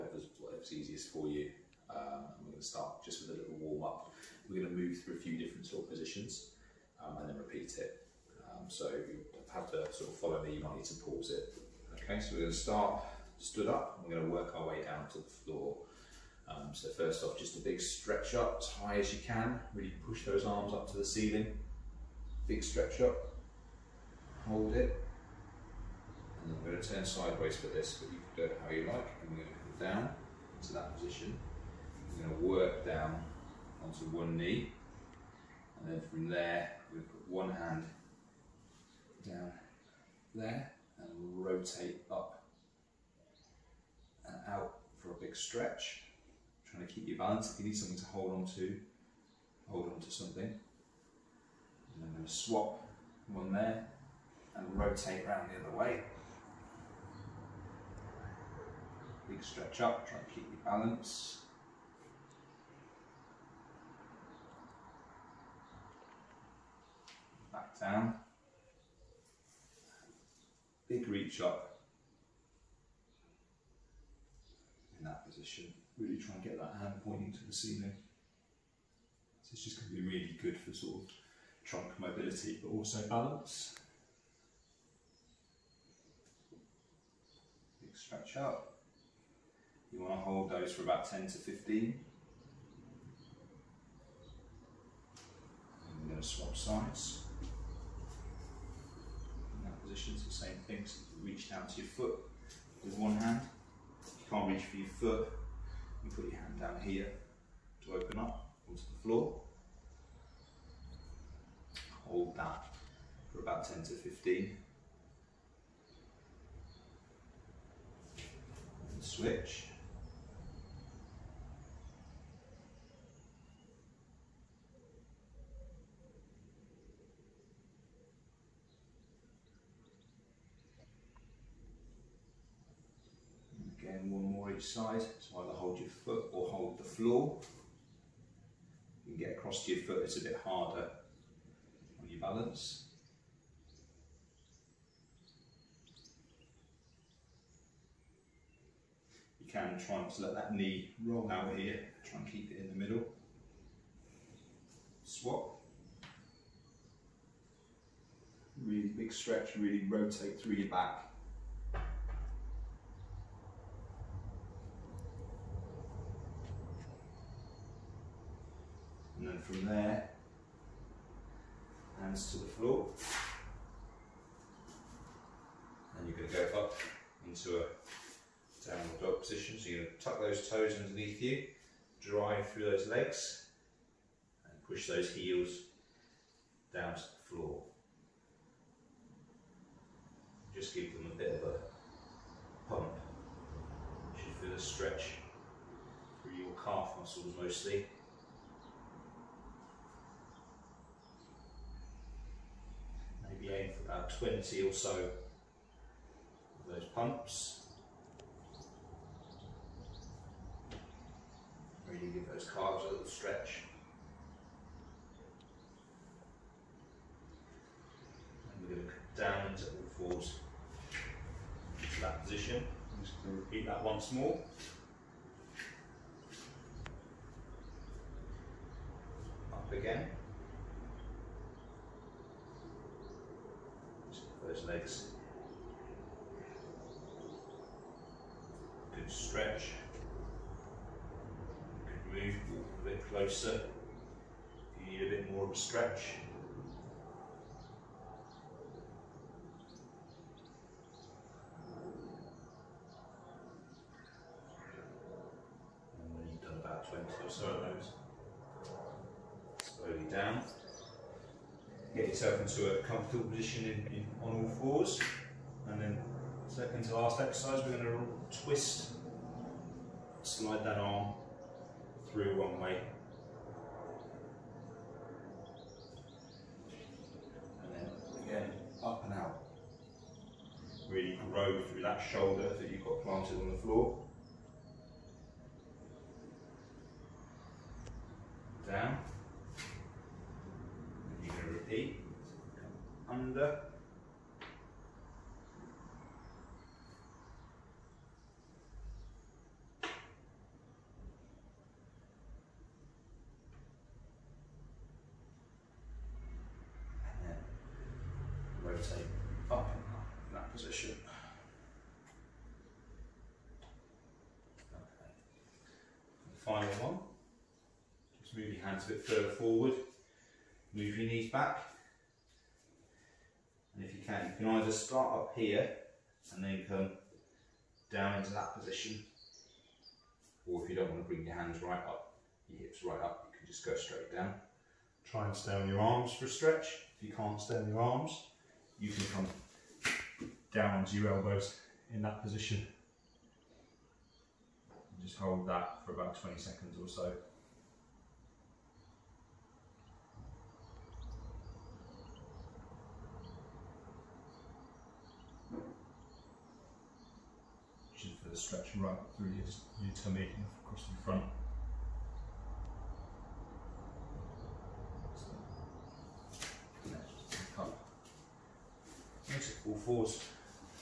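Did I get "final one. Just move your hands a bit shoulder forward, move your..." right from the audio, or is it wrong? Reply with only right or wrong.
wrong.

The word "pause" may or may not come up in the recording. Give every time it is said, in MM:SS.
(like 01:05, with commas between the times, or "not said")
00:11.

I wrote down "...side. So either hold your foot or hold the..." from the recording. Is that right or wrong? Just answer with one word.
right.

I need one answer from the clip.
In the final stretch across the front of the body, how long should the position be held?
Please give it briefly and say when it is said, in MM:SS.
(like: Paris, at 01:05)
about 20 seconds, at 05:45.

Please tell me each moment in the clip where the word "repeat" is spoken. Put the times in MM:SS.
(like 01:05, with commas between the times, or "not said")
00:07, 03:43.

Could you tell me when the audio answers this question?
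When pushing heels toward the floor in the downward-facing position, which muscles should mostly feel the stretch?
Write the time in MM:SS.
03:16.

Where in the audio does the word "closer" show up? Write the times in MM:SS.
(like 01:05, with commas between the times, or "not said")
04:03.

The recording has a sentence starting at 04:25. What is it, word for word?
And then second to last exercise, we're going to twist, slide that arm through one way.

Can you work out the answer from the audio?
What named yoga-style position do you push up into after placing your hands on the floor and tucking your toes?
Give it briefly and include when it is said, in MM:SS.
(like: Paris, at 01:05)
downward dog, at 02:58.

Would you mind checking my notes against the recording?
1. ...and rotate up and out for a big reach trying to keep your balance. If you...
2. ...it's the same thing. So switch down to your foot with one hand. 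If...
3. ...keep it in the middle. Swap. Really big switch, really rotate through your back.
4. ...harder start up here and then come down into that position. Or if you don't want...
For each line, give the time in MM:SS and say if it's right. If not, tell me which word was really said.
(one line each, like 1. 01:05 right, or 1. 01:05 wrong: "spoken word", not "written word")
1. 00:40 wrong: "stretch", not "reach"
2. 01:40 wrong: "reach", not "switch"
3. 02:32 wrong: "stretch", not "switch"
4. 05:24 wrong: "either", not "harder".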